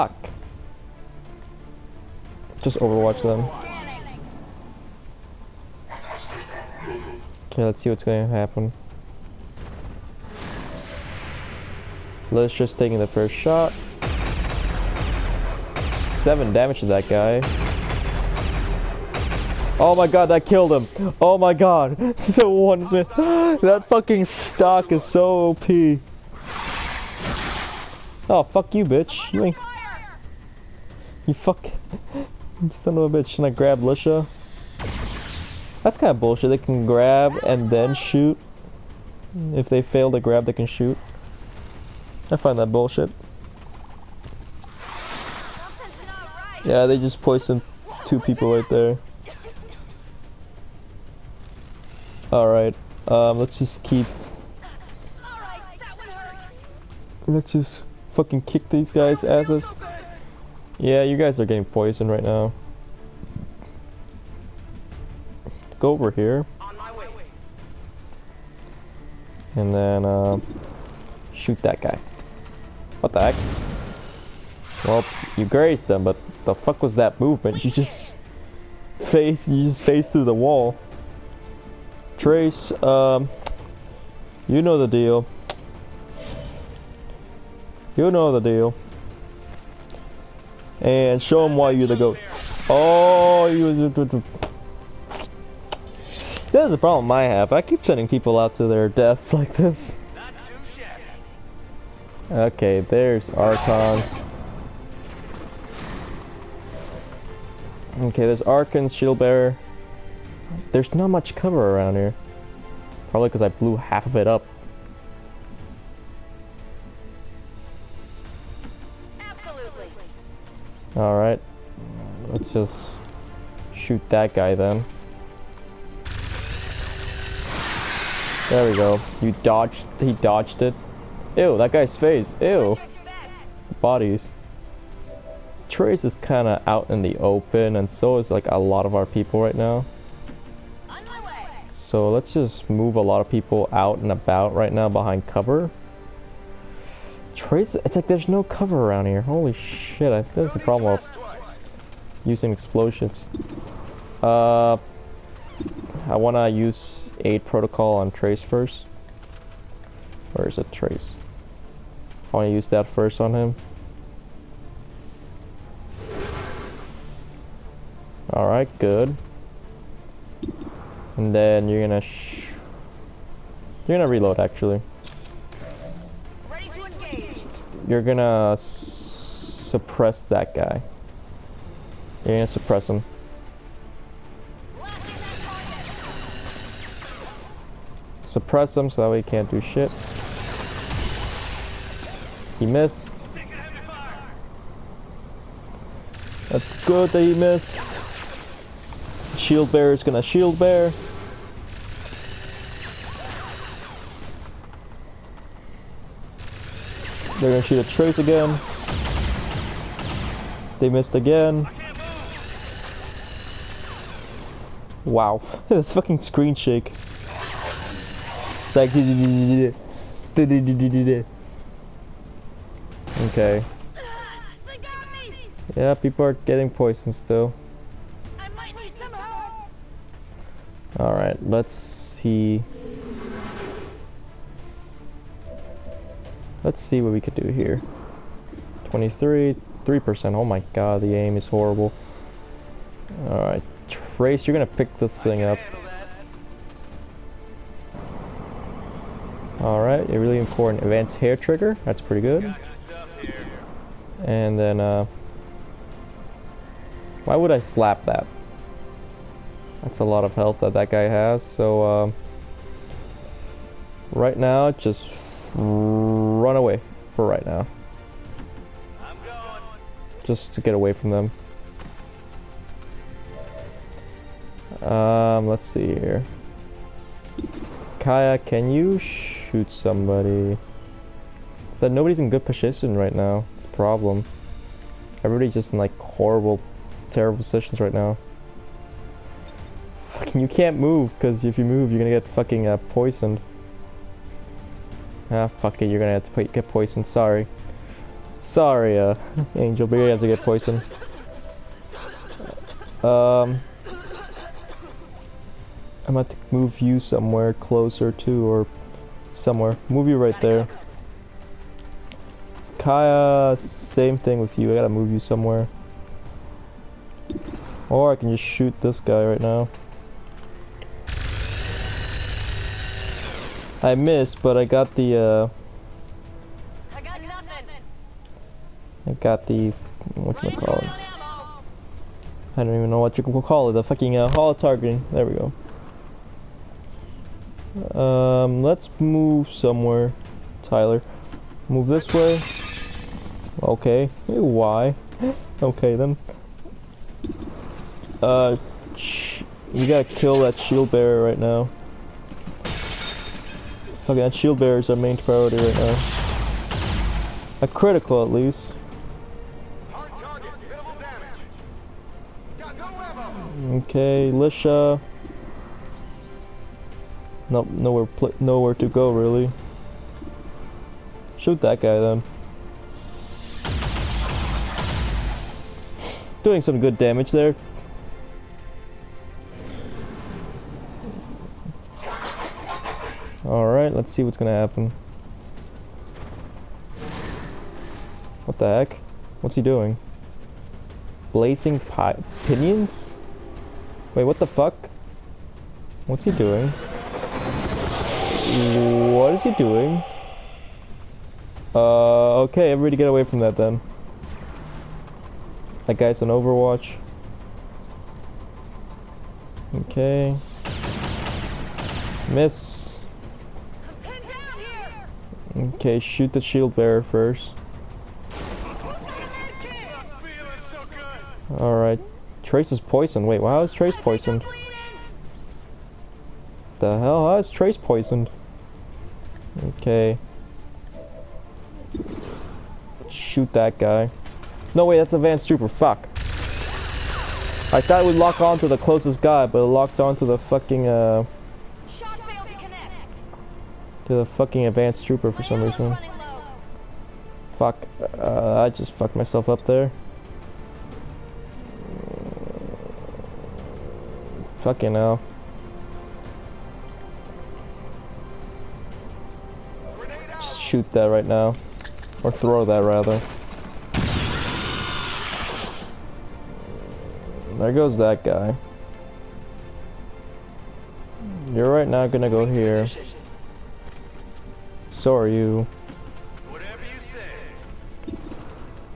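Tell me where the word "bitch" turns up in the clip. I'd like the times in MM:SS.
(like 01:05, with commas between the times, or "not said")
00:28, 00:33.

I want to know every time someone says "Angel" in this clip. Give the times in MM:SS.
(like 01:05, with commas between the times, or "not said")
04:59.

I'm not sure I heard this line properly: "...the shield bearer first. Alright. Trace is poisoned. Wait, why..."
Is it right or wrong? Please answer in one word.
right.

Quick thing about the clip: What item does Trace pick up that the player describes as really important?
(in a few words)
Advanced hair trigger.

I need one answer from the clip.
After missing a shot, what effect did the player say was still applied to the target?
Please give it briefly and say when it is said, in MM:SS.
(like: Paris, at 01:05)
Holo targeting, at 05:34.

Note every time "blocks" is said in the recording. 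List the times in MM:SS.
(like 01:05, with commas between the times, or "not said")
not said.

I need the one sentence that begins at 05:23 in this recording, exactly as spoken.
I missed, but I got the, uh...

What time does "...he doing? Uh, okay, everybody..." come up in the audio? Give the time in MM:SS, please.
06:39.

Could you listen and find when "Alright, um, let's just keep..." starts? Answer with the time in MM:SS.
00:52.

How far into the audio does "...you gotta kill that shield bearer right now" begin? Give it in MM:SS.
05:49.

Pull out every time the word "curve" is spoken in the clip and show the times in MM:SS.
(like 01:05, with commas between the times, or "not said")
not said.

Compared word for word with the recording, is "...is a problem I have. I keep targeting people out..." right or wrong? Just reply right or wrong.
wrong.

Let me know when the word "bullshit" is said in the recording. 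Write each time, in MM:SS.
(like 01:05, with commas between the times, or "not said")
00:36, 00:42.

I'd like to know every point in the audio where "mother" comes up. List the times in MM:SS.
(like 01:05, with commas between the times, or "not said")
not said.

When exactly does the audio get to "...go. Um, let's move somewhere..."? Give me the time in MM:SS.
05:37.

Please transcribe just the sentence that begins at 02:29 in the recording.
Holy shit, I, that's the problem with using explosives.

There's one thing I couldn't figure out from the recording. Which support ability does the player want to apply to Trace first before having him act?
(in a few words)
Aid protocol.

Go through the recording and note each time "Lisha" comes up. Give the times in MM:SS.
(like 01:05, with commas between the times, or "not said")
00:33, 06:04.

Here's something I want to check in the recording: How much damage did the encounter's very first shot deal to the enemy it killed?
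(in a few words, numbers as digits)
7.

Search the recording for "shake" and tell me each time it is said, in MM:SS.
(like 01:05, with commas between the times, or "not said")
03:36.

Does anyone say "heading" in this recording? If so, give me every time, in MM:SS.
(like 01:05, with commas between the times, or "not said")
not said.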